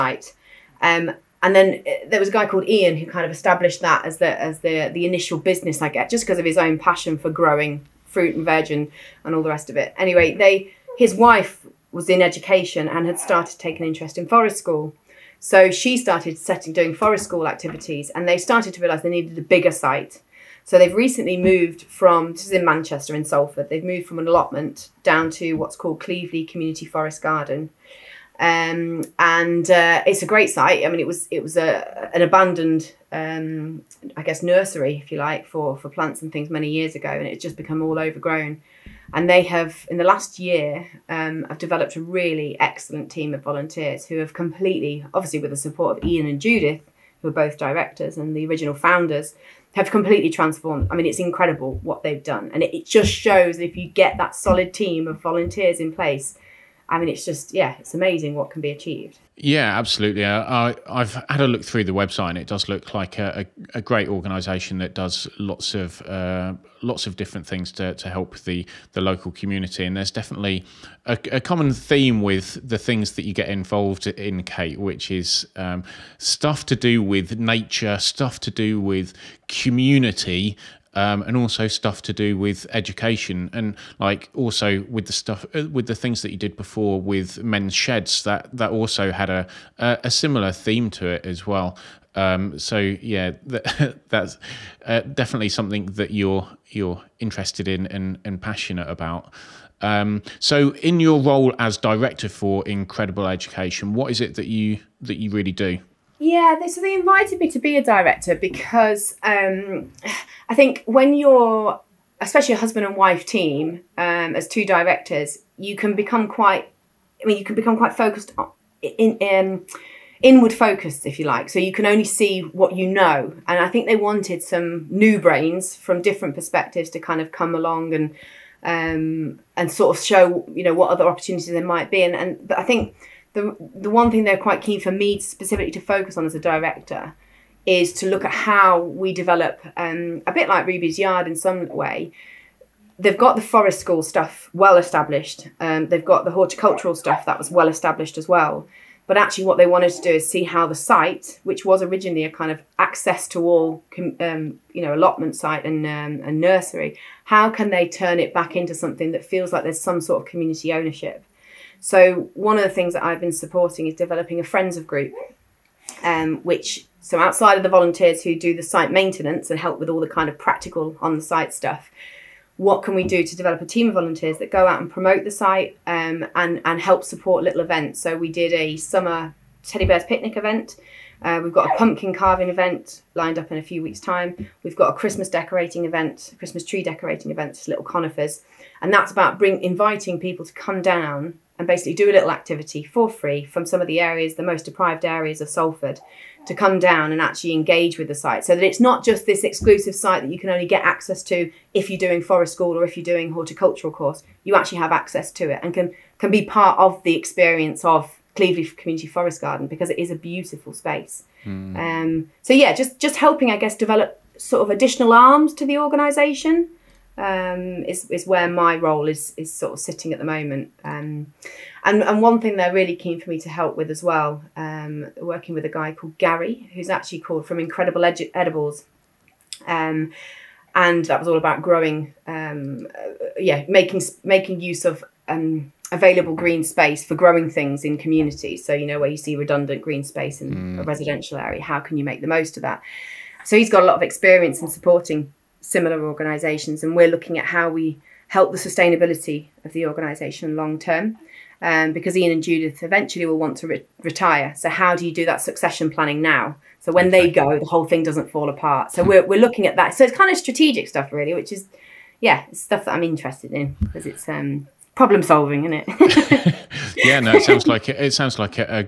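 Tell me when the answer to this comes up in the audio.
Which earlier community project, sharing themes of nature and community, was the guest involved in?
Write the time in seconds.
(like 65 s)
87 s.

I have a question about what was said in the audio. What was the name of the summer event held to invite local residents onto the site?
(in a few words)
Teddy bears picnic.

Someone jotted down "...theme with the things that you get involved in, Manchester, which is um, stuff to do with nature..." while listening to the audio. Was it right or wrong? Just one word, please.
wrong.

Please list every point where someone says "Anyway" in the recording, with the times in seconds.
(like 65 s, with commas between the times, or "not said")
9 s.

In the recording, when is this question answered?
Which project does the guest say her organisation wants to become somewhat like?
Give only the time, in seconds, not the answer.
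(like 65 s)
140 s.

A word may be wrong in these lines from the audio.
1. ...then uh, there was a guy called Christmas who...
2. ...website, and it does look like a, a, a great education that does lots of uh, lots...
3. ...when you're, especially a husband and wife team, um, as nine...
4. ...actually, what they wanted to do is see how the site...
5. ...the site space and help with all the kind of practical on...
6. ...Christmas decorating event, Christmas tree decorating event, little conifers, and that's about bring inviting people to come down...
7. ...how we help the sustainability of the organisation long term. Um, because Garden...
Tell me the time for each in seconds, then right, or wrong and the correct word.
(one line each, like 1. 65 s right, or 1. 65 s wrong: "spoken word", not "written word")
1. 1 s wrong: "Ian", not "Christmas"
2. 61 s wrong: "organisation", not "education"
3. 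110 s wrong: "two", not "nine"
4. 149 s right
5. 168 s wrong: "maintenance", not "space"
6. 184 s right
7. 247 s wrong: "Ian", not "Garden".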